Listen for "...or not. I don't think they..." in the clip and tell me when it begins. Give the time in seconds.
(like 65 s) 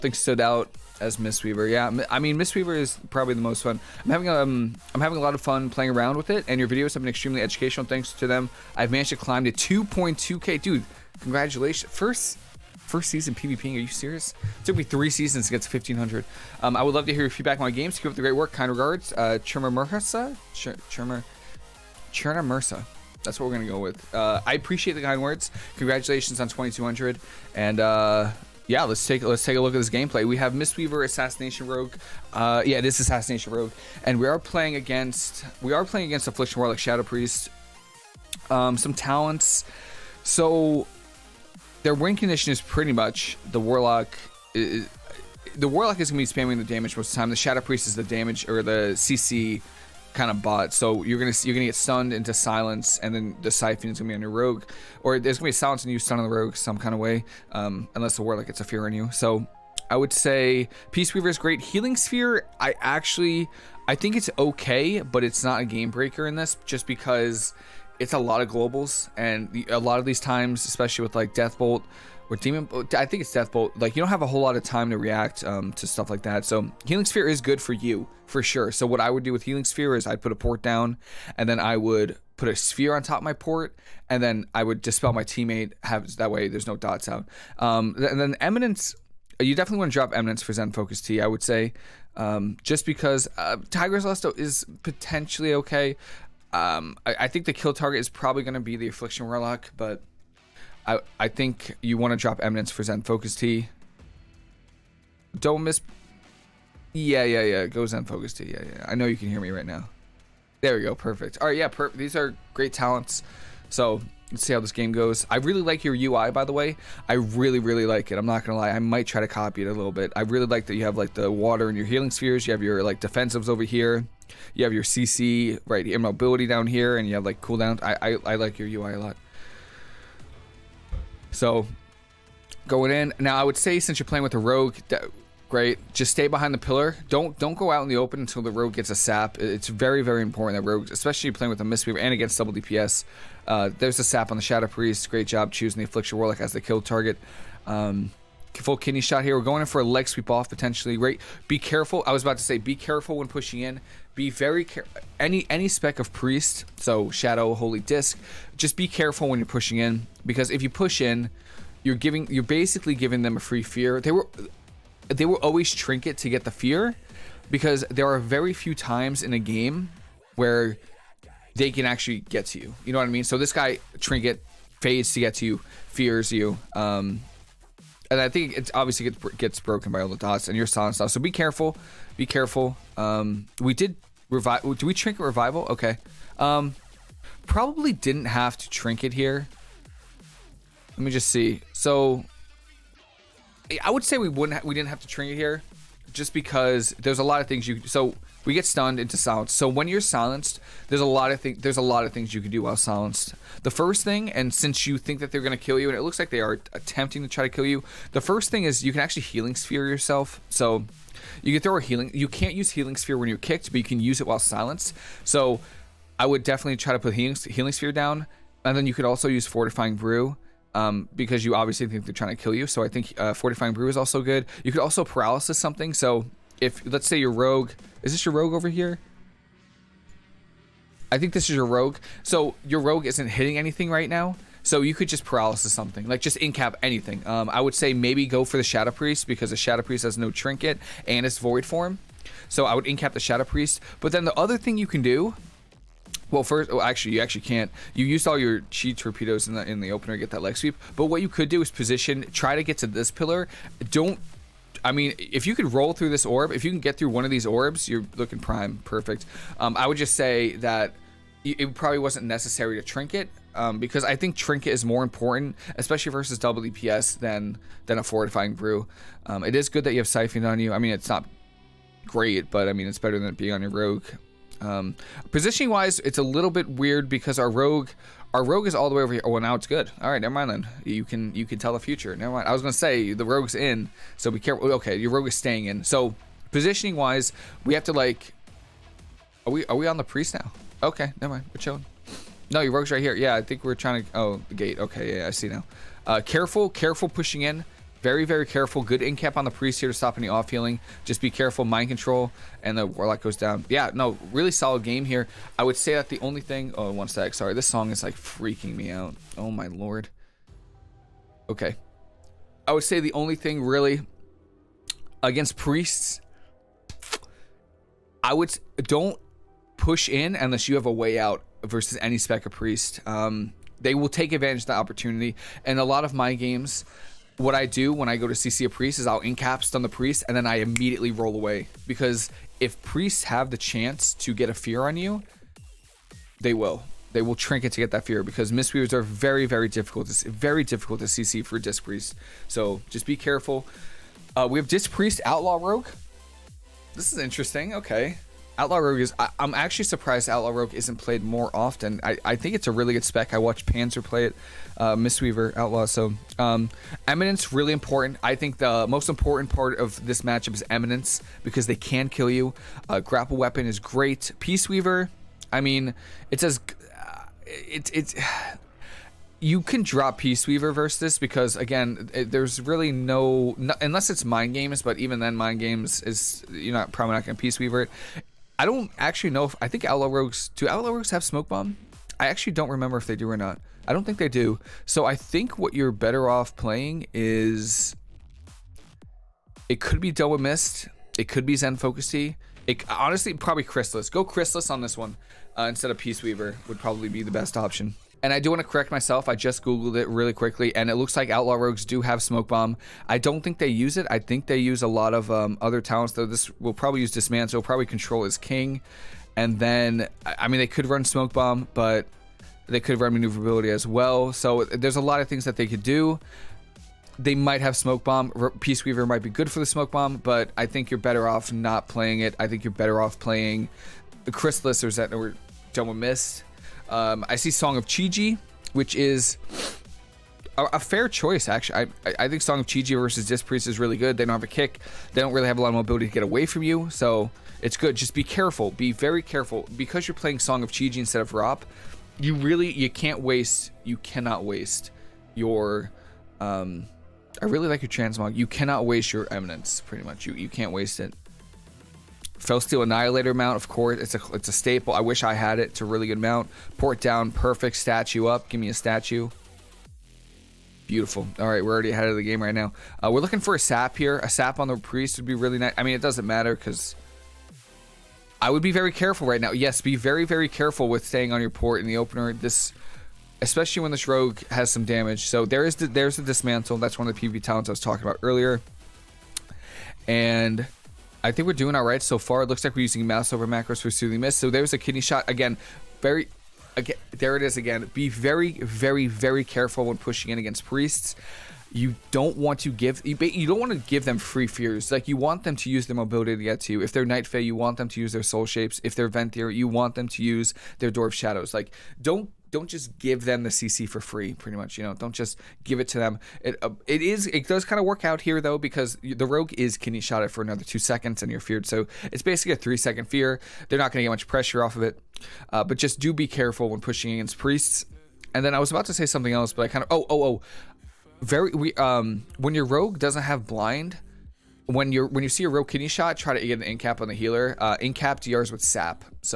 383 s.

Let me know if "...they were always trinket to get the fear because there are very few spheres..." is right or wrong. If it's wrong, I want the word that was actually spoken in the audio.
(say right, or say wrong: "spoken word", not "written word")
wrong: "times", not "spheres".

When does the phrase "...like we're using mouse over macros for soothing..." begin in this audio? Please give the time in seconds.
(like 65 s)
482 s.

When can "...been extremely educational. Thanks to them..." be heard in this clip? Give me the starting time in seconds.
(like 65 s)
7 s.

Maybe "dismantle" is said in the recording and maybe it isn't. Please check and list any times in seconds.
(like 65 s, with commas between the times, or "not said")
407 s, 476 s.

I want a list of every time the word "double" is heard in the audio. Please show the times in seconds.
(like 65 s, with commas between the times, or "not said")
142 s, 266 s, 390 s.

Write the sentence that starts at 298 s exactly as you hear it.
Good in cap on the priest here to stop any off healing.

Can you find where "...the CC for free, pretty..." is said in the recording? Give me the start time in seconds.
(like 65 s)
503 s.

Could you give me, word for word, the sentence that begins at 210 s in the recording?
So you can throw a healing.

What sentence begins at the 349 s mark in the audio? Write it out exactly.
I, am actually surprised Outlaw Rogue isn't played more often.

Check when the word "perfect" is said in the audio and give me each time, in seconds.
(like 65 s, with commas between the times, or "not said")
110 s, 258 s, 457 s.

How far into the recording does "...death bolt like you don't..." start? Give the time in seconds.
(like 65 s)
73 s.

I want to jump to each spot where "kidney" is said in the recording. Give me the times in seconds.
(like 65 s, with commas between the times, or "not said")
148 s, 484 s, 509 s, 525 s.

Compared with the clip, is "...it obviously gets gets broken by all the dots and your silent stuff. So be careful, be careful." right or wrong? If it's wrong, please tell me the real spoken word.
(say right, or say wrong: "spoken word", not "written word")
right.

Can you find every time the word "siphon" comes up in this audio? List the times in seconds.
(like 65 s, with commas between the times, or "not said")
53 s, 270 s.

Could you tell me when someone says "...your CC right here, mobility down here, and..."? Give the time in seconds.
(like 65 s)
124 s.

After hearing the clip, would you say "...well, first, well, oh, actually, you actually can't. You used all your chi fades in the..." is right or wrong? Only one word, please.
wrong.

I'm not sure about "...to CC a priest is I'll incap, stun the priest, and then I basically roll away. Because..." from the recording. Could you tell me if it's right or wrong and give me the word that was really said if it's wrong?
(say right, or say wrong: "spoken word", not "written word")
wrong: "immediately", not "basically".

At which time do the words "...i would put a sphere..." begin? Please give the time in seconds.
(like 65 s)
81 s.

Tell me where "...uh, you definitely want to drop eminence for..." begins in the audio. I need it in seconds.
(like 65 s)
89 s.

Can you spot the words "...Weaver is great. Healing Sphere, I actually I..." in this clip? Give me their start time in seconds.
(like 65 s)
61 s.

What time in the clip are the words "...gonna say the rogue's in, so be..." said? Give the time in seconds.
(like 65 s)
282 s.